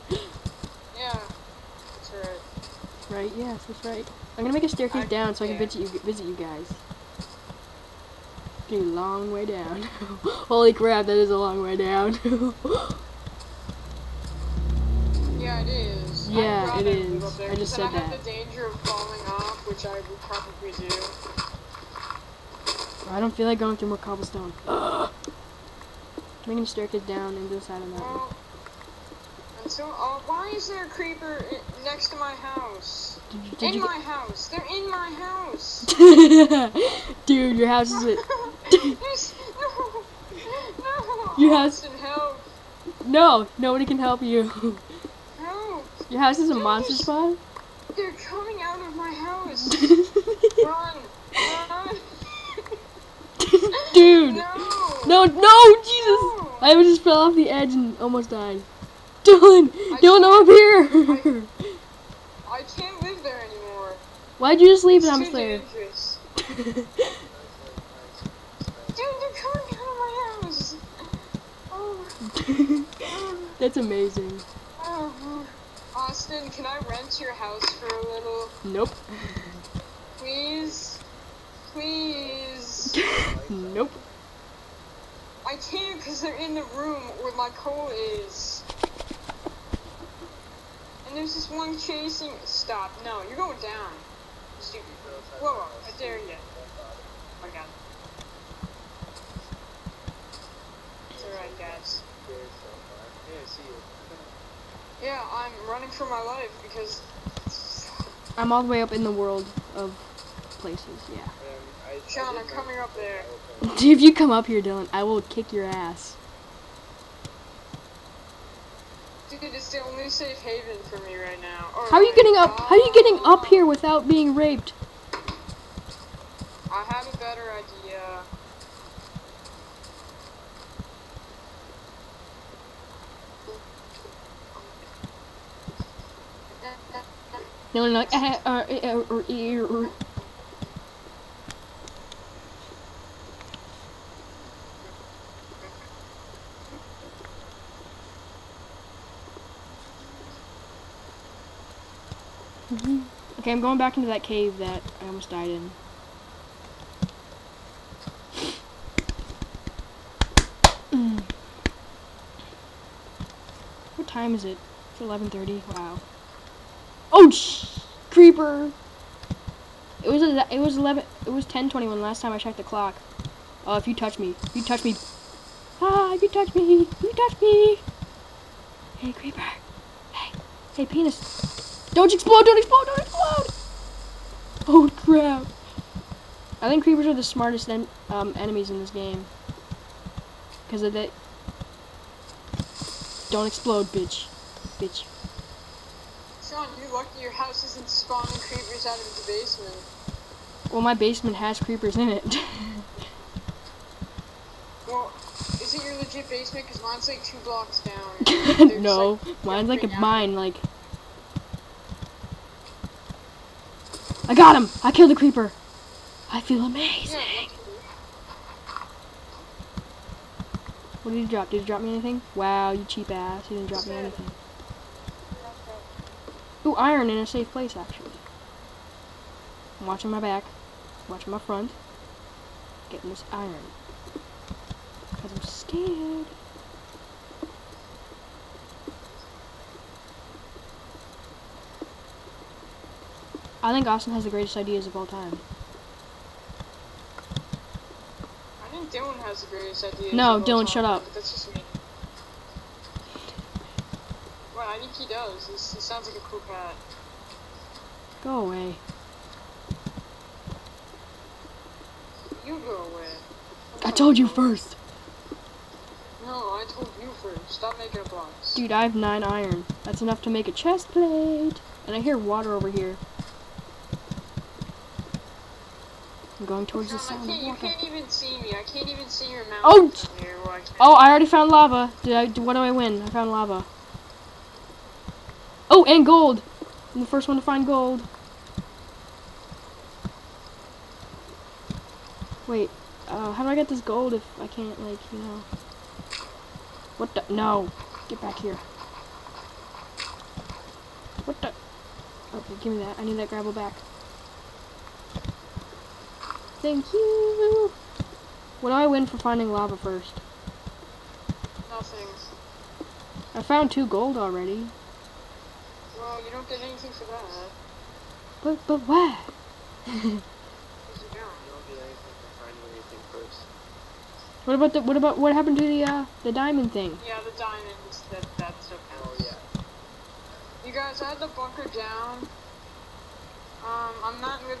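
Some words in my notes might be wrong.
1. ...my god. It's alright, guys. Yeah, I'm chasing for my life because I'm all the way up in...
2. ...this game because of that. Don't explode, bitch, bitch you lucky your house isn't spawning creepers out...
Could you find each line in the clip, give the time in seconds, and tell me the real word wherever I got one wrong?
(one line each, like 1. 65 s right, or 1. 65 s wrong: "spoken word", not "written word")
1. 97 s wrong: "running", not "chasing"
2. 188 s right.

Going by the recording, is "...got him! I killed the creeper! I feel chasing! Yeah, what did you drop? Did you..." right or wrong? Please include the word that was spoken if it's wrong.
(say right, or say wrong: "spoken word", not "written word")
wrong: "amazing", not "chasing".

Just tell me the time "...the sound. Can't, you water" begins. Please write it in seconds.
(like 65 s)
276 s.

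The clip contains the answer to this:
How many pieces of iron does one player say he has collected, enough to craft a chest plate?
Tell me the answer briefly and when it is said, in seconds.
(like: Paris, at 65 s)
9, at 268 s.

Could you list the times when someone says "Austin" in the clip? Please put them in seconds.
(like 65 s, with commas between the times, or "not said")
75 s, 243 s.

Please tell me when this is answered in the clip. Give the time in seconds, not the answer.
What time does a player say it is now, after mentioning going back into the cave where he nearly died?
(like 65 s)
165 s.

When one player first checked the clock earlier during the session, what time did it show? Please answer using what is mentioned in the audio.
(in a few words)
10:21.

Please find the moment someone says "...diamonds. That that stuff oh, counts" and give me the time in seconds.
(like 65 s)
327 s.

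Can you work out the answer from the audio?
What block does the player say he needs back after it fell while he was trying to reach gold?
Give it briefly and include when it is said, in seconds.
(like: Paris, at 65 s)
Gravel, at 303 s.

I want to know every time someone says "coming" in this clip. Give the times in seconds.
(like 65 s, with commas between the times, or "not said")
48 s, 112 s.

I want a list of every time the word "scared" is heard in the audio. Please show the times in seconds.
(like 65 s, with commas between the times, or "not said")
235 s.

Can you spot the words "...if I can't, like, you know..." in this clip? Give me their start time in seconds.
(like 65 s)
294 s.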